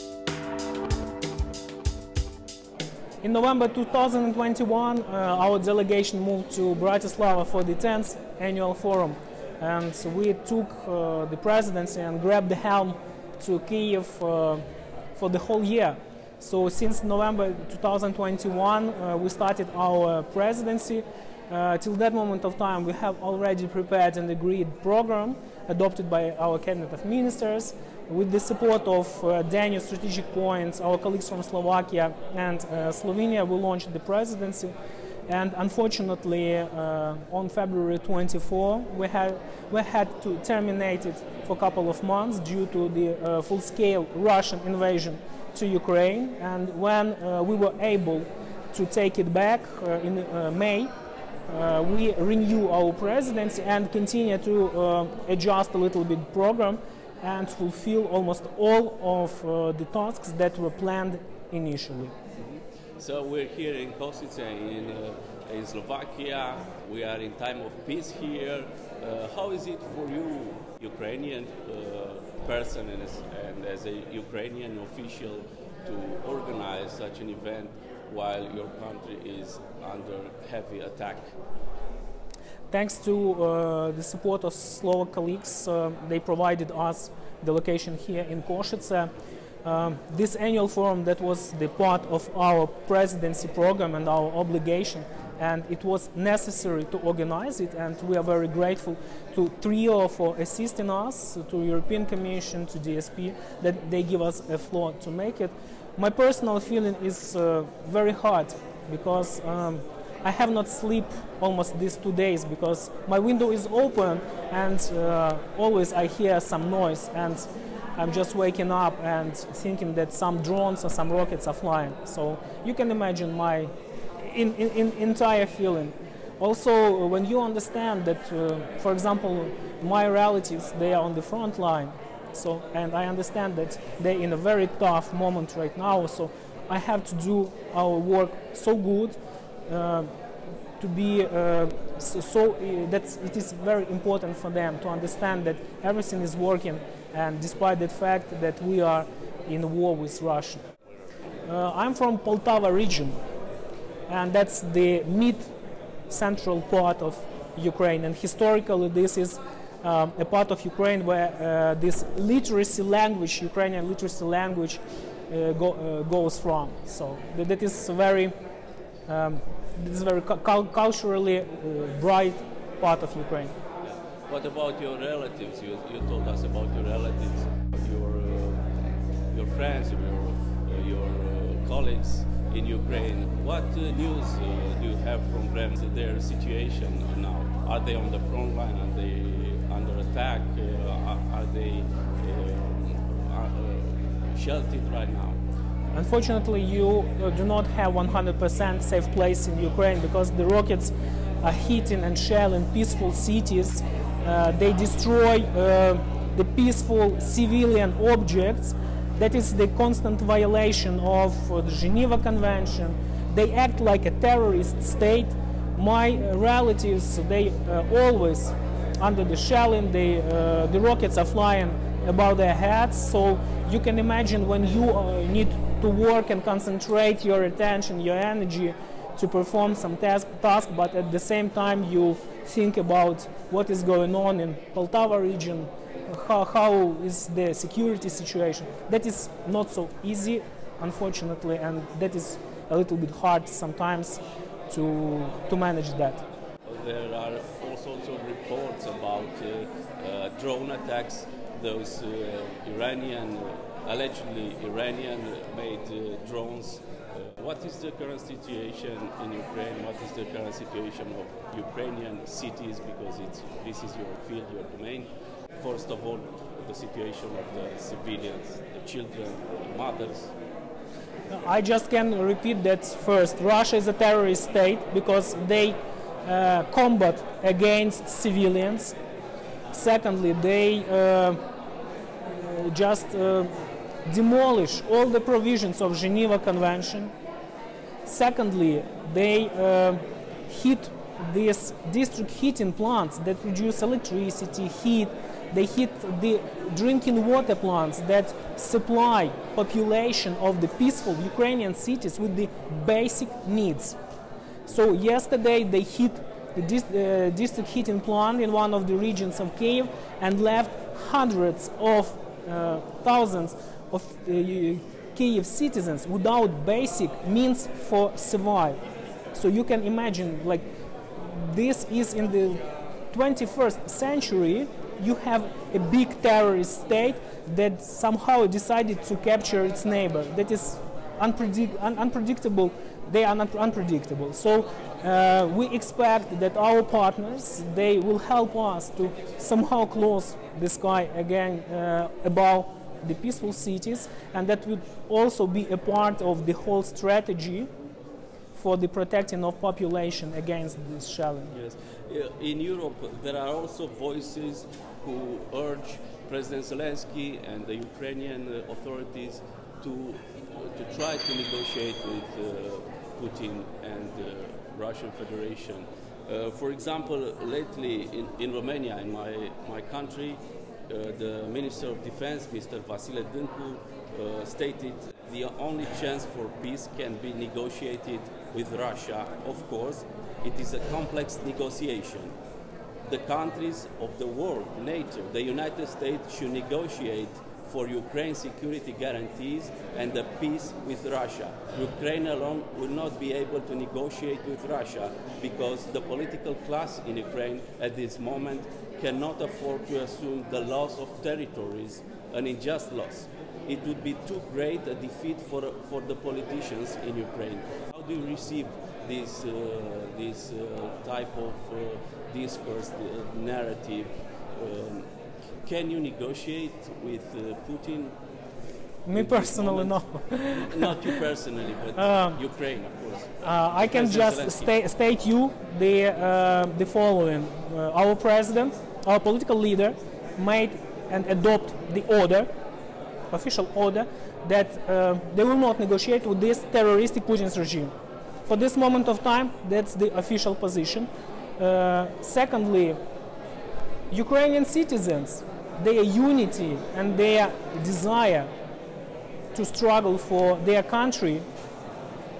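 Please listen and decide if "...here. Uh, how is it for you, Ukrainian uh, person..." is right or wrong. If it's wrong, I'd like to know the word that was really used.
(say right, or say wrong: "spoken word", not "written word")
right.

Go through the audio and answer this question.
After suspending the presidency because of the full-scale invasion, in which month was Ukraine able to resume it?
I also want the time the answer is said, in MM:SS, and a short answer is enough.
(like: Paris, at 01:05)
May, at 00:50.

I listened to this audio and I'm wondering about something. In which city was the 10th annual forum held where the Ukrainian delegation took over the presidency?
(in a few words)
Bratislava.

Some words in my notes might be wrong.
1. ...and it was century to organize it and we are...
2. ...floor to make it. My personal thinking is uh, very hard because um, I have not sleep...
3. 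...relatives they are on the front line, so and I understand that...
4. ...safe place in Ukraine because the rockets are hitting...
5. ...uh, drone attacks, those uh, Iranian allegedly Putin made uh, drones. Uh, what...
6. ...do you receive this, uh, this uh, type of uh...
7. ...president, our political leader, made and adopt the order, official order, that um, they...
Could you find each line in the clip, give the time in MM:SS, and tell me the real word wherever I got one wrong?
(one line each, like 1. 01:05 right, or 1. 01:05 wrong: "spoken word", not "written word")
1. 01:35 wrong: "necessary", not "century"
2. 01:44 wrong: "feeling", not "thinking"
3. 02:10 right
4. 03:18 right
5. 04:10 wrong: "Iranian", not "Putin"
6. 06:48 right
7. 07:08 right.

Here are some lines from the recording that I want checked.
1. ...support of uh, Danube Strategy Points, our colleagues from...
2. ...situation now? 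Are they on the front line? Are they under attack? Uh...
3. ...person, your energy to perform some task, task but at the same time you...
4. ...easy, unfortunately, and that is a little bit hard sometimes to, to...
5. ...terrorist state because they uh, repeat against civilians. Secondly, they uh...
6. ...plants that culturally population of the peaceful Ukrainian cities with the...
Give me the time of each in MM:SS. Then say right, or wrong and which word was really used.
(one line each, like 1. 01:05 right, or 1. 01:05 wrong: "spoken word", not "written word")
1. 00:28 right
2. 03:06 right
3. 03:47 wrong: "attention", not "person"
4. 04:00 right
5. 04:33 wrong: "combat", not "repeat"
6. 04:57 wrong: "supply", not "culturally".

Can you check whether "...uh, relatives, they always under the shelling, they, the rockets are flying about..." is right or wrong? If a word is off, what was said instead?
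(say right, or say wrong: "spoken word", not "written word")
right.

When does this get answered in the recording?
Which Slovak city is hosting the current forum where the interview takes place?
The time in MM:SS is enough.
01:03.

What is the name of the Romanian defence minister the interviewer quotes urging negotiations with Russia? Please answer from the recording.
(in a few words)
Vasile Dâncu.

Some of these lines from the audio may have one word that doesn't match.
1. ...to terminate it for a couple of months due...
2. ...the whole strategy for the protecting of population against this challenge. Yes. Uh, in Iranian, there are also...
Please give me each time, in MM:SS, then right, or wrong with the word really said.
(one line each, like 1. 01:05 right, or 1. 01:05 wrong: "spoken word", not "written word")
1. 00:40 right
2. 05:46 wrong: "Europe", not "Iranian".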